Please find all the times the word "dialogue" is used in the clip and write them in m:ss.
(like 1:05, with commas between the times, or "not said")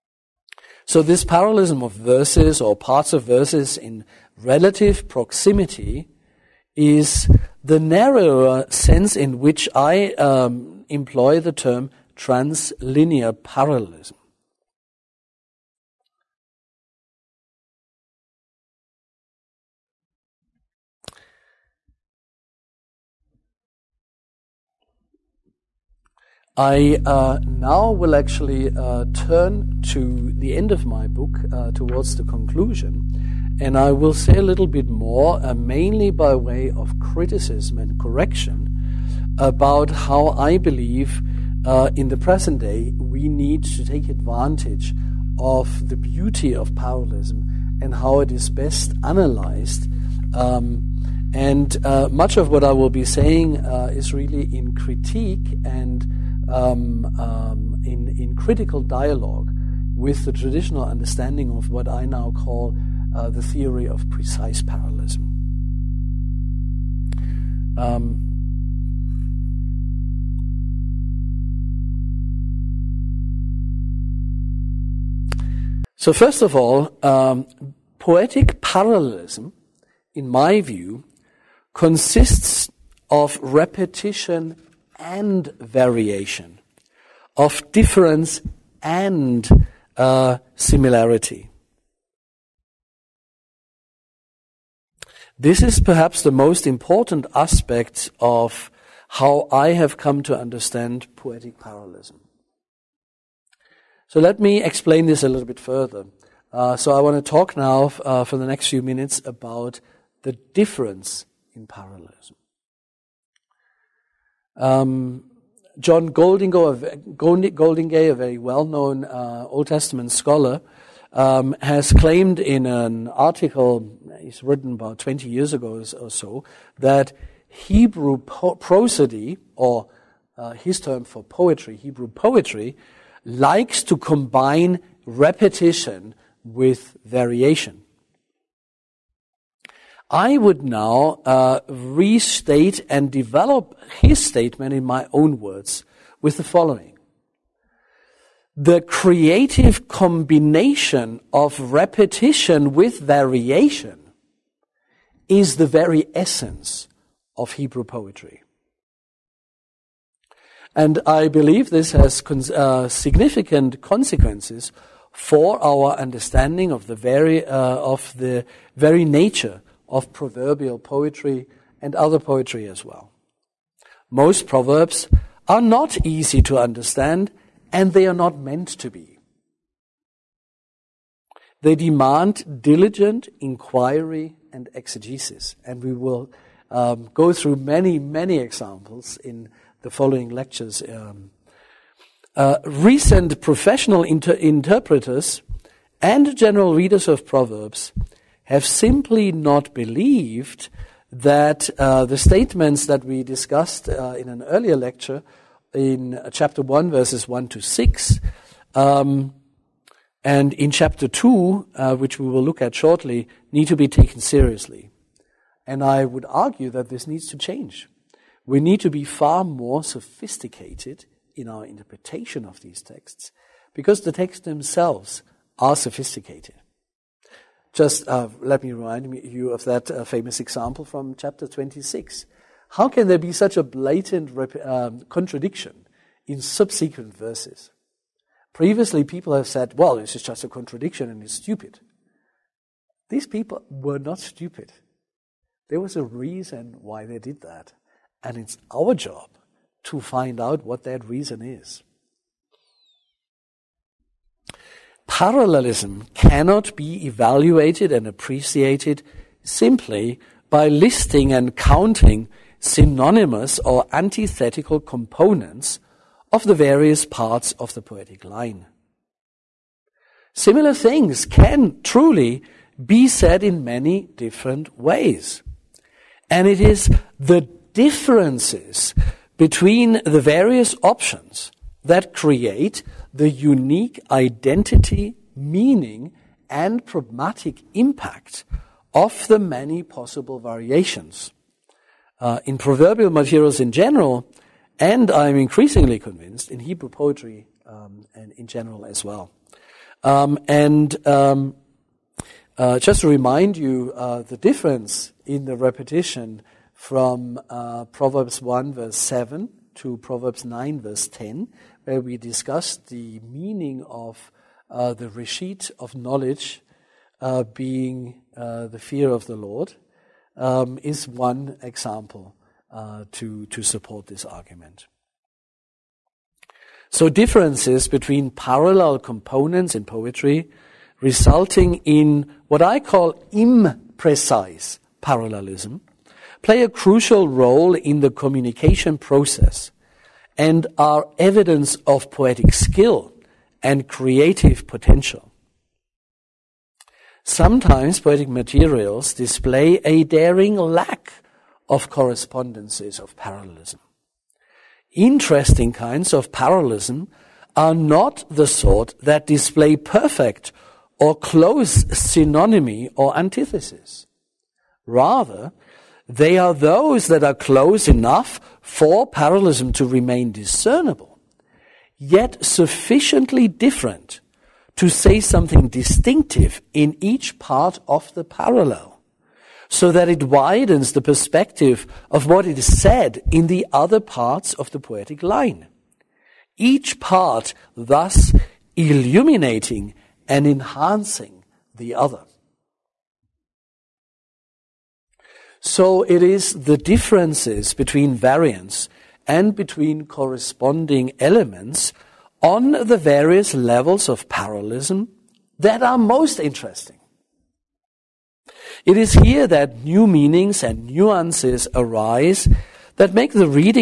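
0:58.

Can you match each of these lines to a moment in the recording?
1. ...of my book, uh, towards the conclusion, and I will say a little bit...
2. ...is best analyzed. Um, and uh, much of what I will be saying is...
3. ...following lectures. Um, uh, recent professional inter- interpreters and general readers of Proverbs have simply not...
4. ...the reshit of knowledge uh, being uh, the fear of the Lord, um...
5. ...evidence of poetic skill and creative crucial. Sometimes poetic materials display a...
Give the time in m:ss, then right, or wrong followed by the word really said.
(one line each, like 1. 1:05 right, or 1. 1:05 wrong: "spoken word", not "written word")
1. 0:30 right
2. 0:48 right
3. 3:09 right
4. 5:14 right
5. 5:41 wrong: "potential", not "crucial".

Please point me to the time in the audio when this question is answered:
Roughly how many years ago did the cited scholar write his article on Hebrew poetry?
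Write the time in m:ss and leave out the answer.
2:04.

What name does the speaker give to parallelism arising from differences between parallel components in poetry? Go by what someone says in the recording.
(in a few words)
imprecise parallelism.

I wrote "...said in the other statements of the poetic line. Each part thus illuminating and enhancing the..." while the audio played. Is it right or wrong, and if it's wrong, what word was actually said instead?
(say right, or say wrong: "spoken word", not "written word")
wrong: "parts", not "statements".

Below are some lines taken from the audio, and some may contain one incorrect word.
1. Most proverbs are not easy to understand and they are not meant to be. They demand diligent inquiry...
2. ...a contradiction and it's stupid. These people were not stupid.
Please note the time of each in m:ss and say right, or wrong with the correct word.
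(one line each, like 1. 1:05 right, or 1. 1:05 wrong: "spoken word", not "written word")
1. 2:54 right
2. 4:00 right.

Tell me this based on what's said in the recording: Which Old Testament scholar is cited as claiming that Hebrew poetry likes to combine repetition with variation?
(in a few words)
John Goldingay.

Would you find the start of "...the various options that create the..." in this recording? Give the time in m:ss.
4:40.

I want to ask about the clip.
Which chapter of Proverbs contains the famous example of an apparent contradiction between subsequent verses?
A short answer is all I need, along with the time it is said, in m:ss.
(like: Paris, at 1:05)
Chapter 26, at 3:51.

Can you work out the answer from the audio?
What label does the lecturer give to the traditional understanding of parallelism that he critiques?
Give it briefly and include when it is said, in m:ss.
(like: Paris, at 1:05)
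theory of precise parallelism, at 1:03.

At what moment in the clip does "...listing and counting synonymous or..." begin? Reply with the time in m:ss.
4:20.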